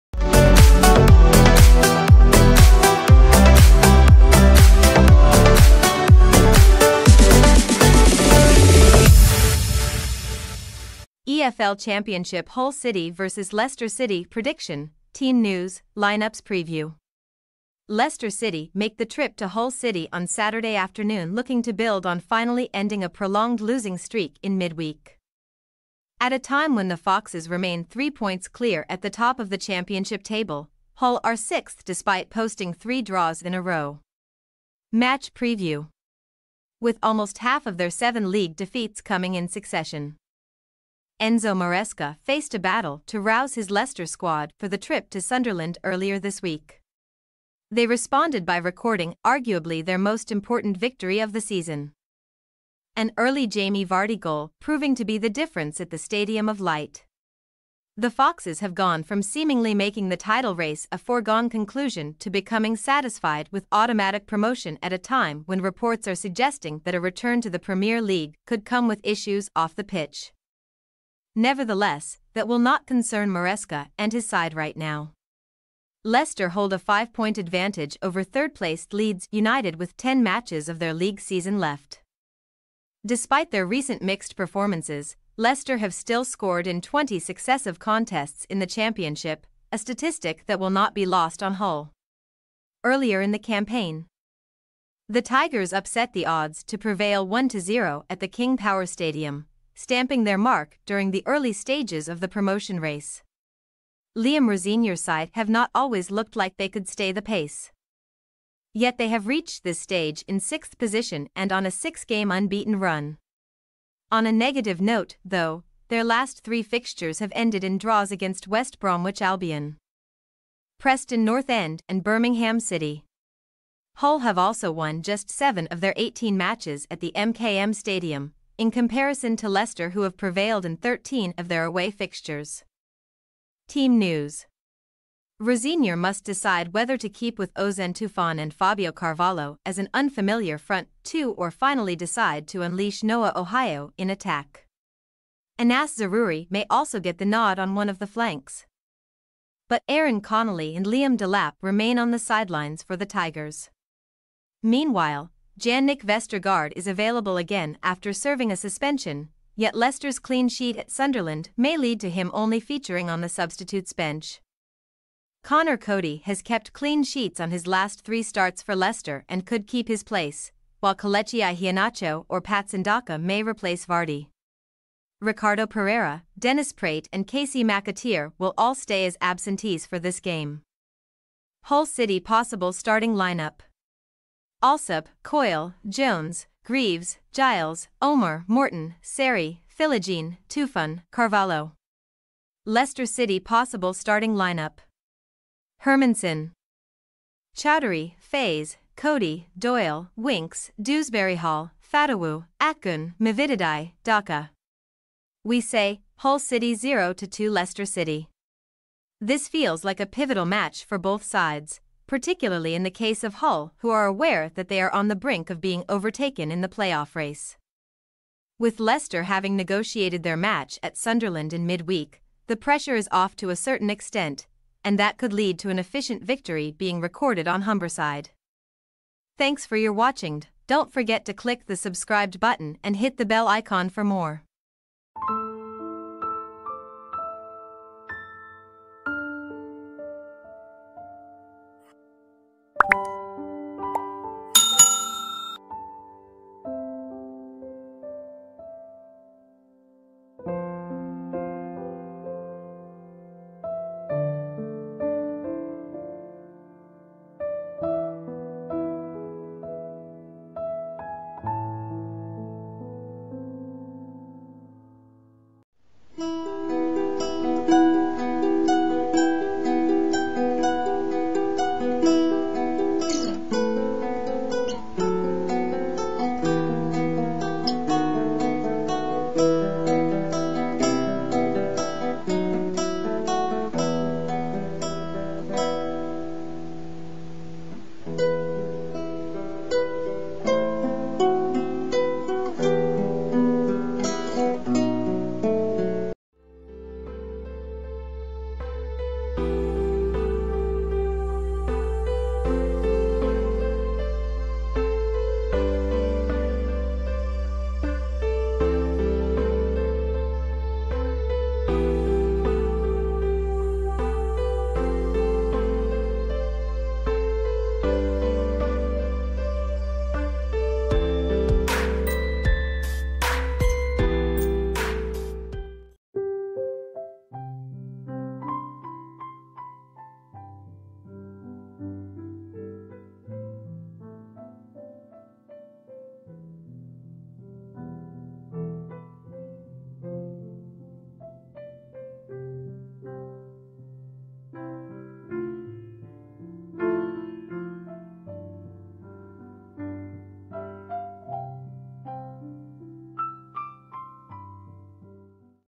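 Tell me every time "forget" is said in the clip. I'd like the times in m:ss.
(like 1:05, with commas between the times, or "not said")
3:50.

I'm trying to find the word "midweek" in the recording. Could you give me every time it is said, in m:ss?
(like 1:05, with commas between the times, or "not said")
0:24, 3:41.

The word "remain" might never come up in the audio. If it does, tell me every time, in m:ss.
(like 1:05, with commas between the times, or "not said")
0:27, 2:31.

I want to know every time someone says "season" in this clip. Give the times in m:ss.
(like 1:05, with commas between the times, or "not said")
0:51, 1:21.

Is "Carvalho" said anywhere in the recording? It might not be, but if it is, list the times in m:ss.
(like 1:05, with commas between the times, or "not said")
2:18, 3:11.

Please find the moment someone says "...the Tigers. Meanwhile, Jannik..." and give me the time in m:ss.
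2:32.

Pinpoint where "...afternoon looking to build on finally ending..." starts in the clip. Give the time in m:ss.
0:20.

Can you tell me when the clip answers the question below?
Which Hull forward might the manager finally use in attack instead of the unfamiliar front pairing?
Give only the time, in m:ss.
2:23.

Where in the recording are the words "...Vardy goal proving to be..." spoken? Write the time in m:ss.
0:53.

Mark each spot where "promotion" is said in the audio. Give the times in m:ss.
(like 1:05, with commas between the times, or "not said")
1:04, 1:42.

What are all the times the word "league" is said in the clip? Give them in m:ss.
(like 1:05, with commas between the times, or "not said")
0:38, 1:08, 1:20.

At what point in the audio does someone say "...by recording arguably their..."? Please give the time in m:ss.
0:48.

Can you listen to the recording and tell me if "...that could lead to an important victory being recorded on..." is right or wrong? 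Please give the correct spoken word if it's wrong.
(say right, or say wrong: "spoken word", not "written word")
wrong: "efficient", not "important".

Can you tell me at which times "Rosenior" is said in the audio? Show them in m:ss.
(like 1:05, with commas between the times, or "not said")
1:44, 2:15.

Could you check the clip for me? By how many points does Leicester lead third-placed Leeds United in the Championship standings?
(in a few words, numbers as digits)
5.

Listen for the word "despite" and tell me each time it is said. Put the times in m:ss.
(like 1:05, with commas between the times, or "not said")
0:31, 1:23.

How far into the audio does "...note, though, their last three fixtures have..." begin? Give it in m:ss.
1:54.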